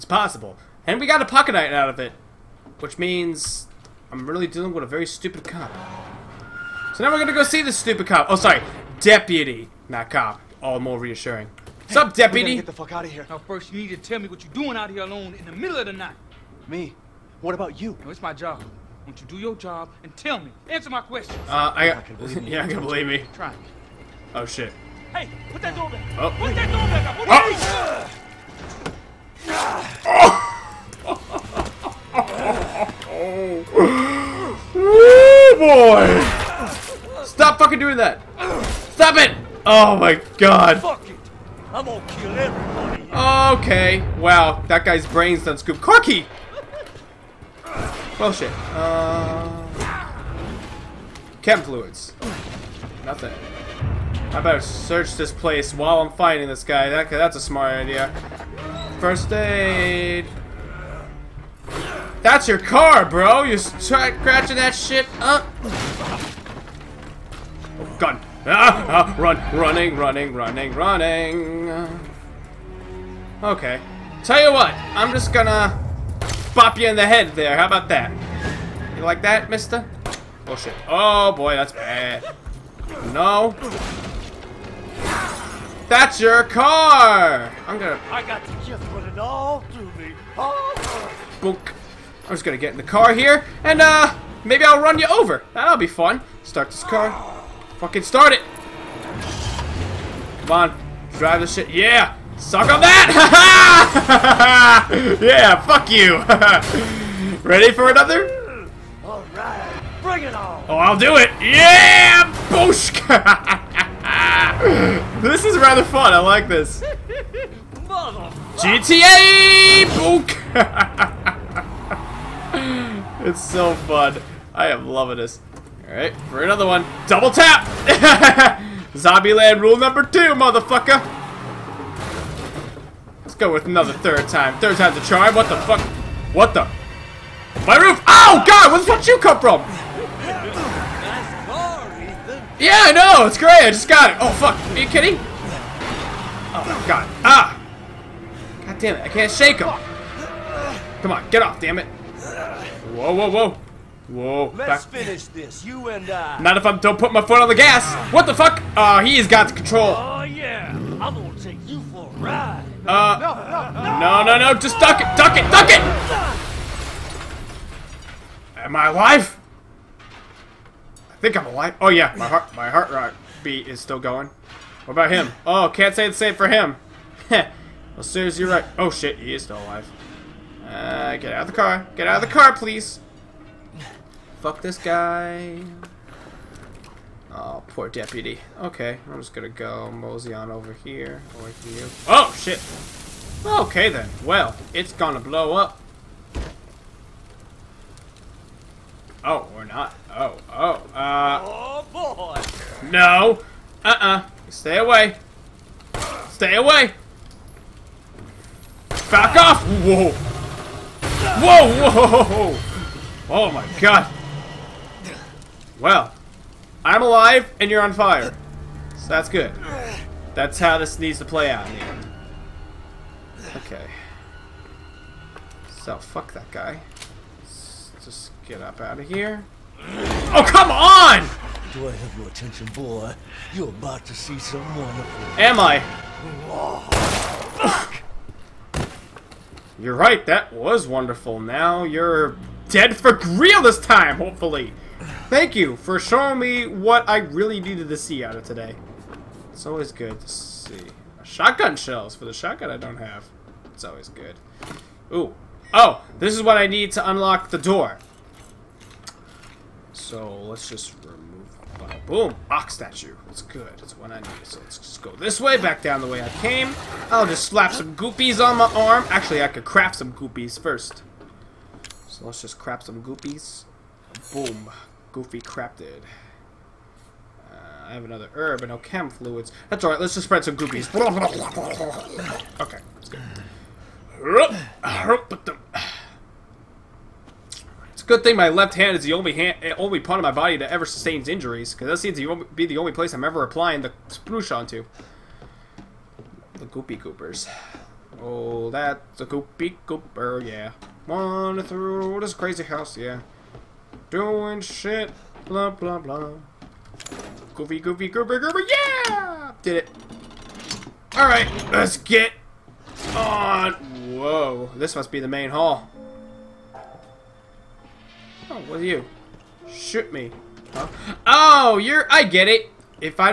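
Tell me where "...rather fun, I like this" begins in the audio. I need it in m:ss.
1:55.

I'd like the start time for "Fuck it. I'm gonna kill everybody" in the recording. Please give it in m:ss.
0:40.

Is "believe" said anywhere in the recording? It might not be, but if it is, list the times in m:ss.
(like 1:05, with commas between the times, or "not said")
0:22.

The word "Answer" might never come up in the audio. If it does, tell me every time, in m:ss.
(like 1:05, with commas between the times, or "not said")
0:20.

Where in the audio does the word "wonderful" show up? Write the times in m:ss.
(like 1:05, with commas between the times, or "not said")
3:54, 4:00.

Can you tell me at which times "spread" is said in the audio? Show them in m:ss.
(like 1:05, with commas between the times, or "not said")
4:40.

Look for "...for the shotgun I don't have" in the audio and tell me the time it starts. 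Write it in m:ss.
4:12.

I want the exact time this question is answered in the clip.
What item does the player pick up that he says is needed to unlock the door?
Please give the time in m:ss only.
4:22.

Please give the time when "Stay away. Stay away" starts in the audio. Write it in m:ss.
3:24.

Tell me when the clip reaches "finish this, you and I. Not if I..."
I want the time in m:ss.
2:35.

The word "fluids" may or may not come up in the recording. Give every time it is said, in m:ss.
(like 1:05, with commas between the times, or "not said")
0:51, 4:39.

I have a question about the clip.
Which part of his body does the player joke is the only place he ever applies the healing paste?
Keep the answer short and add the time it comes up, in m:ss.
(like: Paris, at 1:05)
Left hand, at 4:48.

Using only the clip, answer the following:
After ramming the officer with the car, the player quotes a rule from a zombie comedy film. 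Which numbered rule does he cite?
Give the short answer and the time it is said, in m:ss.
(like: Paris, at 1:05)
Rule number two, at 2:08.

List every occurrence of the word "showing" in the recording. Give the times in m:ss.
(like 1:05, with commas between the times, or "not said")
4:05.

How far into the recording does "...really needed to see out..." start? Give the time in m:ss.
4:07.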